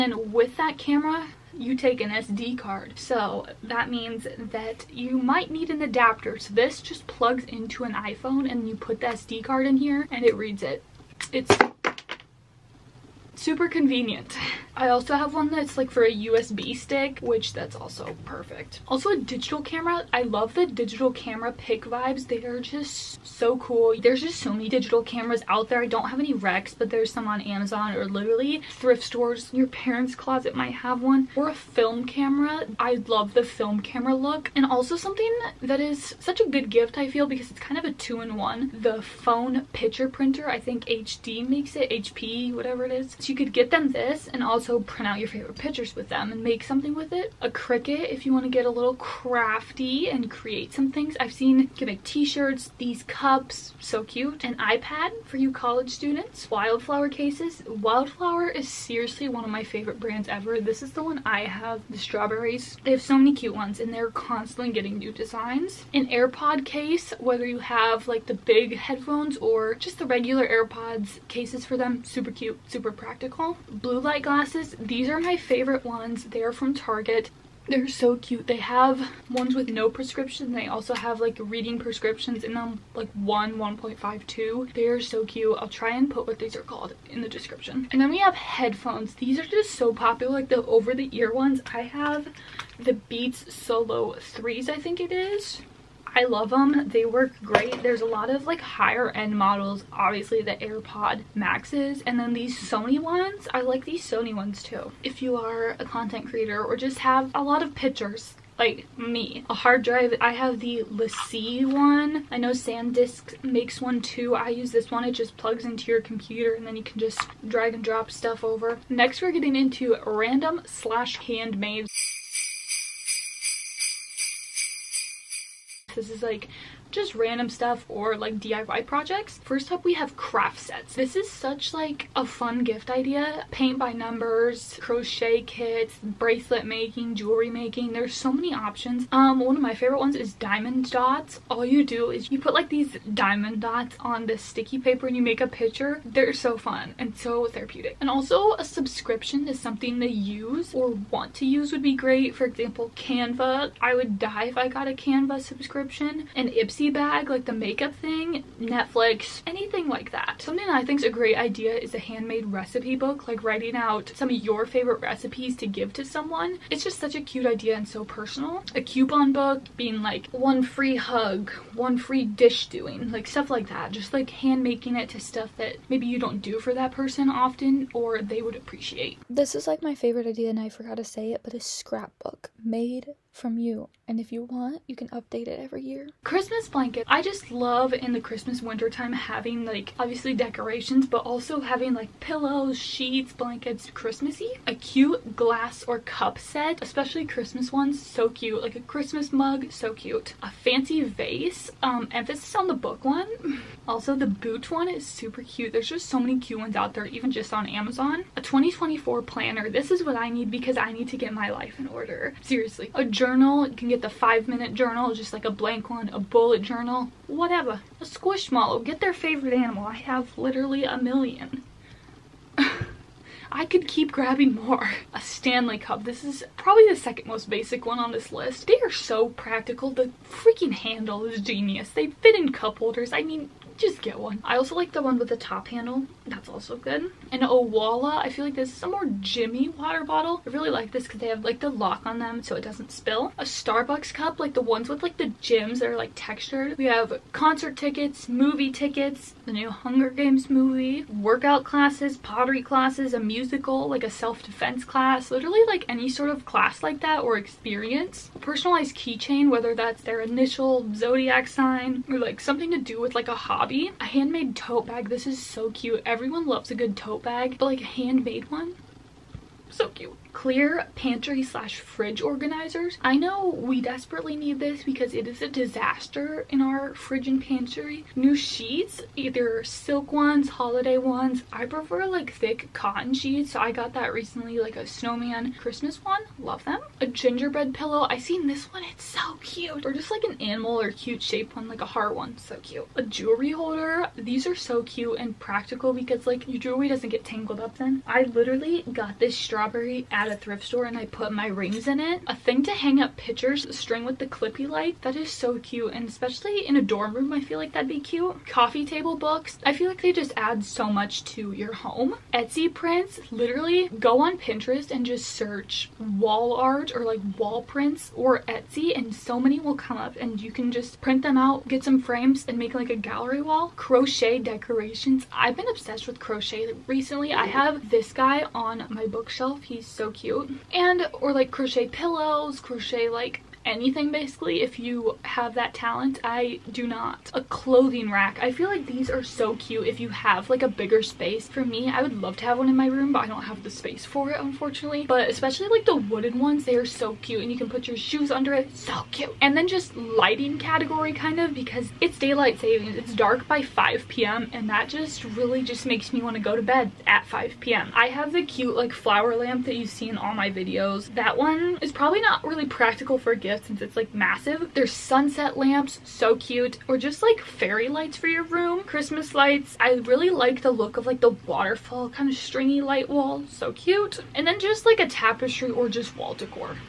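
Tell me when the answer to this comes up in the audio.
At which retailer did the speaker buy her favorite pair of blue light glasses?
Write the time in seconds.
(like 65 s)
76 s.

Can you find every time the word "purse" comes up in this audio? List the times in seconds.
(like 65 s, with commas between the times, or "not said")
not said.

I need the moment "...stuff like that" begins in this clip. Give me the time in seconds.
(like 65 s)
173 s.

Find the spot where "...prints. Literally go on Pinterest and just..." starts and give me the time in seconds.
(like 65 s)
312 s.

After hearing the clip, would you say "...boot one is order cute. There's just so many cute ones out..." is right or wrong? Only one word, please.
wrong.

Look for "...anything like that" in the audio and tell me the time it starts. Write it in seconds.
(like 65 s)
159 s.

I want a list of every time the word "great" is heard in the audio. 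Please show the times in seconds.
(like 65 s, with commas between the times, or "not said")
97 s, 151 s, 161 s.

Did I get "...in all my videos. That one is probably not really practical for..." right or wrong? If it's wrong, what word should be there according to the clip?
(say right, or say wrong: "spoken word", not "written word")
right.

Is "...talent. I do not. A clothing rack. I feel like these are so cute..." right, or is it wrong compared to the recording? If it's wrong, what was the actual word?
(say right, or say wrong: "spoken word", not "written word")
right.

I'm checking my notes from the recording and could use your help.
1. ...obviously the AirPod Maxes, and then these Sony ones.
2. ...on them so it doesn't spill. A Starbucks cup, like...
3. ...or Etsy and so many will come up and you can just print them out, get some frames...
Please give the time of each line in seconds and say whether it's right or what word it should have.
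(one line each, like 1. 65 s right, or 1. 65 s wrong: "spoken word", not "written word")
1. 99 s right
2. 242 s right
3. 318 s right.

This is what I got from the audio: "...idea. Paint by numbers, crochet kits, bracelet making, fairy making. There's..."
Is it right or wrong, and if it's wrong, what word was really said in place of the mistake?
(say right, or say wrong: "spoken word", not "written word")
wrong: "jewelry", not "fairy".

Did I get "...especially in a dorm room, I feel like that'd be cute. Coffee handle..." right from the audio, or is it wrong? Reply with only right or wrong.
wrong.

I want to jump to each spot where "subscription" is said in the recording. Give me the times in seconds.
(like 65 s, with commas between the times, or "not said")
148 s, 155 s.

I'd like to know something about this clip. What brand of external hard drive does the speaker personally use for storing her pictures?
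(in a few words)
LaCie.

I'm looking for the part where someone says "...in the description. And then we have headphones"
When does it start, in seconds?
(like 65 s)
87 s.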